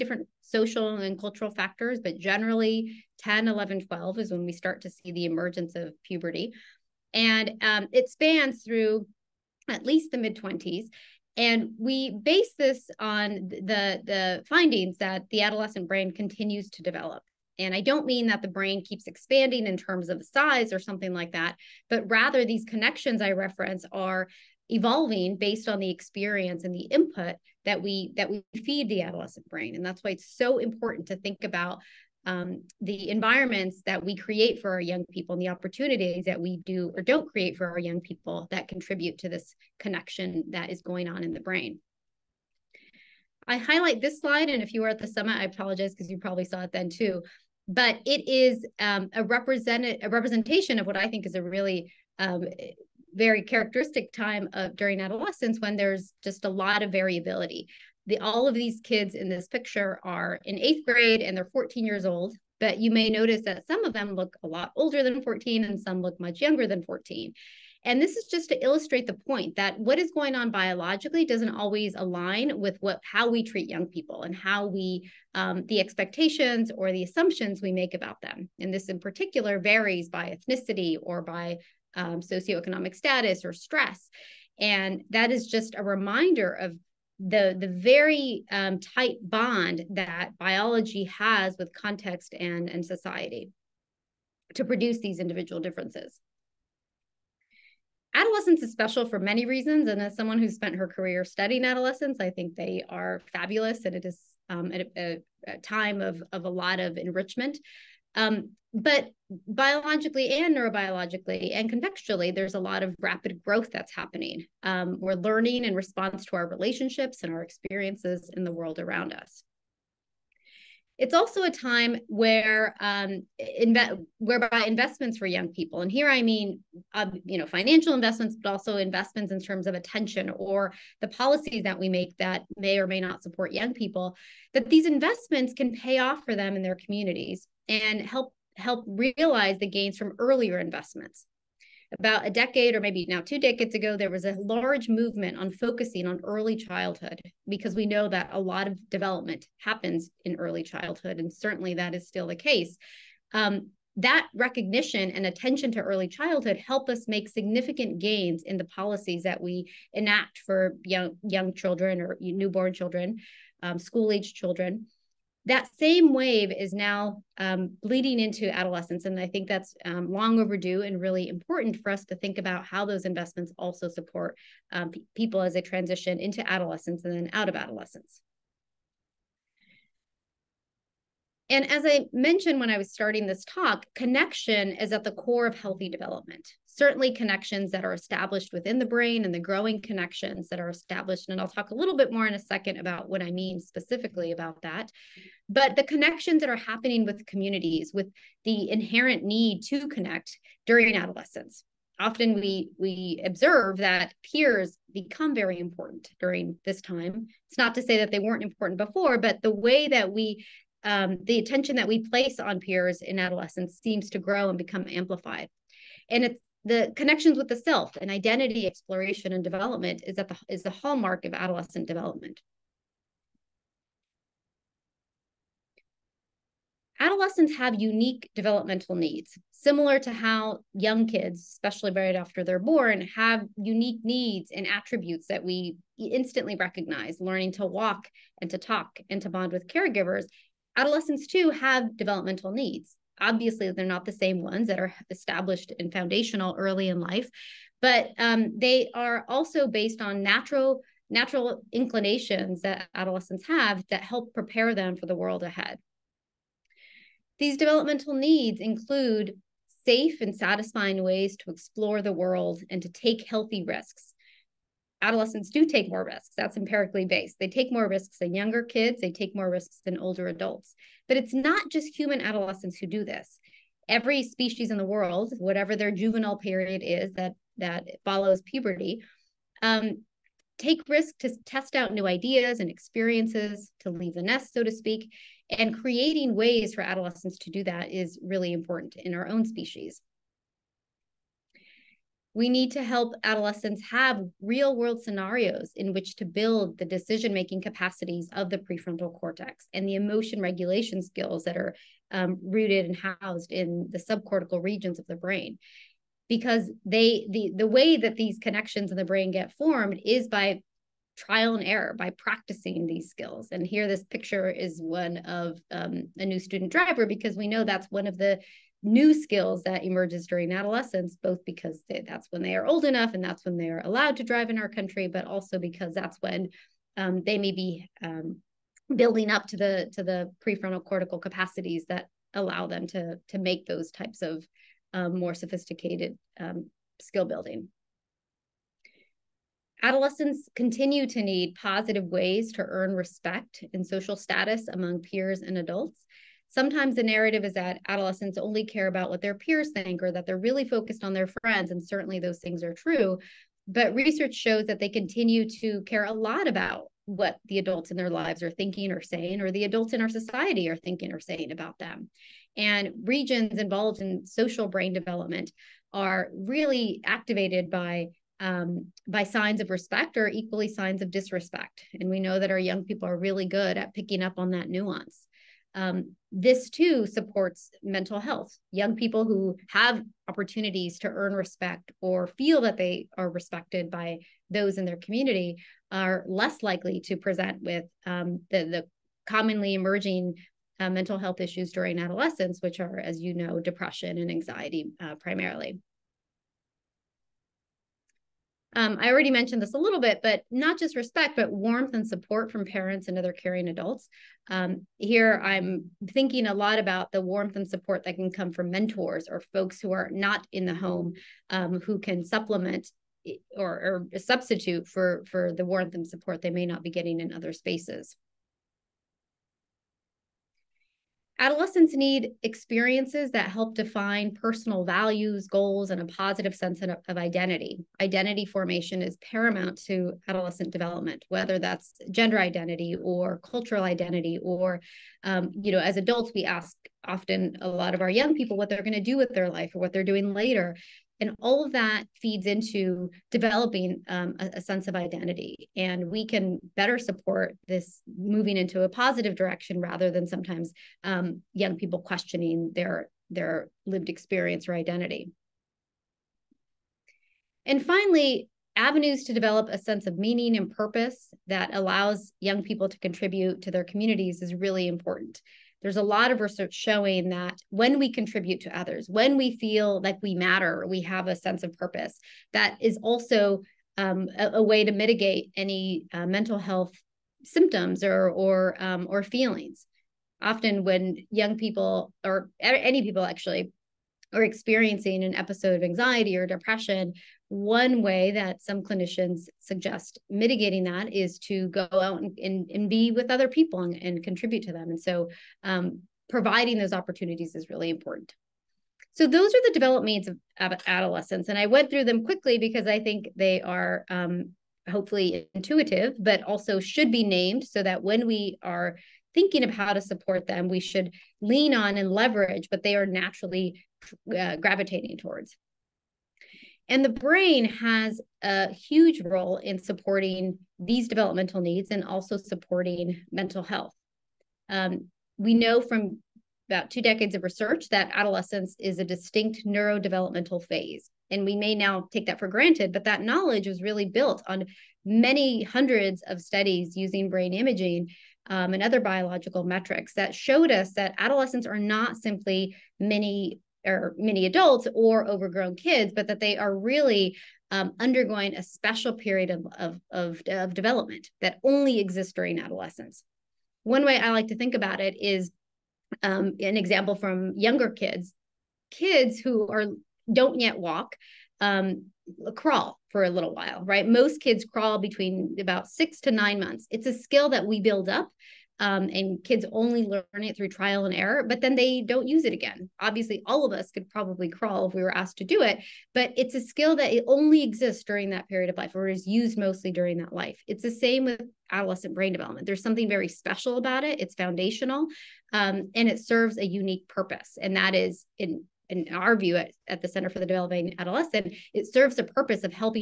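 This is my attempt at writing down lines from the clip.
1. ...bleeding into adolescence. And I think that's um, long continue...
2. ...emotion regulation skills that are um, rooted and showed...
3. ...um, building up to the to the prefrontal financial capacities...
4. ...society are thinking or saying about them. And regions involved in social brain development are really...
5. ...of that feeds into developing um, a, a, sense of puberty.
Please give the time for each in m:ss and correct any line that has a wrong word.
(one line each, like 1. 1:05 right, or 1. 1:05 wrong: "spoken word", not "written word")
1. 2:47 wrong: "overdue", not "continue"
2. 4:59 wrong: "housed", not "showed"
3. 5:28 wrong: "cortical", not "financial"
4. 6:00 right
5. 7:21 wrong: "identity", not "puberty".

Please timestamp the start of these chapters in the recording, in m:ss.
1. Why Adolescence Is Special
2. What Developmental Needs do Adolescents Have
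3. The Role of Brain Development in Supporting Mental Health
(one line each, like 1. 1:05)
1. 1:36
2. 3:51
3. 8:36.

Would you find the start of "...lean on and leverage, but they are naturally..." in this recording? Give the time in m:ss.
8:31.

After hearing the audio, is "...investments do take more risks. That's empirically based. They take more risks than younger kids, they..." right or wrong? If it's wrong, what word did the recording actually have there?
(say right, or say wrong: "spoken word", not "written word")
wrong: "adolescents", not "investments".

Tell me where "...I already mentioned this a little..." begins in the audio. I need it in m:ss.
6:39.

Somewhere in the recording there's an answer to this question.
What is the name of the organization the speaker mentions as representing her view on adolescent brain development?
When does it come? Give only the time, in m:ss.
9:50.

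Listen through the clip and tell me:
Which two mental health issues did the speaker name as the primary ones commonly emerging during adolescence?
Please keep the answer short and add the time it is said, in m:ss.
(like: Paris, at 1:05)
depression and anxiety, at 6:33.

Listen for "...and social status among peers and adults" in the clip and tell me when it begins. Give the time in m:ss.
5:43.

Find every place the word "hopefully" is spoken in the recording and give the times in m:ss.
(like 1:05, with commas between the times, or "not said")
8:24.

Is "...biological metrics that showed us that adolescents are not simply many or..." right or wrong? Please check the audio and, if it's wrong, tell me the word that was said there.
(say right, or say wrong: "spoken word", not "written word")
right.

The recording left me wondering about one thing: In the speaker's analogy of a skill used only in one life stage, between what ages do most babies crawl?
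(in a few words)
6 to 9 months.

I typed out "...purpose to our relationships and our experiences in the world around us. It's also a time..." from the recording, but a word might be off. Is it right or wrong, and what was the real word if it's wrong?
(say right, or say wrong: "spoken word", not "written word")
wrong: "response", not "purpose".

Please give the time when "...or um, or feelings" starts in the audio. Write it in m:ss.
7:58.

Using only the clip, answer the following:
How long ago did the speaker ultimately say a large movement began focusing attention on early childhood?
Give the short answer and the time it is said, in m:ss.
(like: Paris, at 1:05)
a decade, at 2:22.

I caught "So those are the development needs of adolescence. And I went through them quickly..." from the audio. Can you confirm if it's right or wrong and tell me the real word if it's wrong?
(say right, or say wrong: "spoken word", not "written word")
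right.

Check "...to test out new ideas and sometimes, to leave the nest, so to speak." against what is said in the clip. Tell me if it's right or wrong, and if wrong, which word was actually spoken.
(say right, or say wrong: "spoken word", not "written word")
wrong: "experiences", not "sometimes".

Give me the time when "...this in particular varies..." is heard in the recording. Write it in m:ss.
1:18.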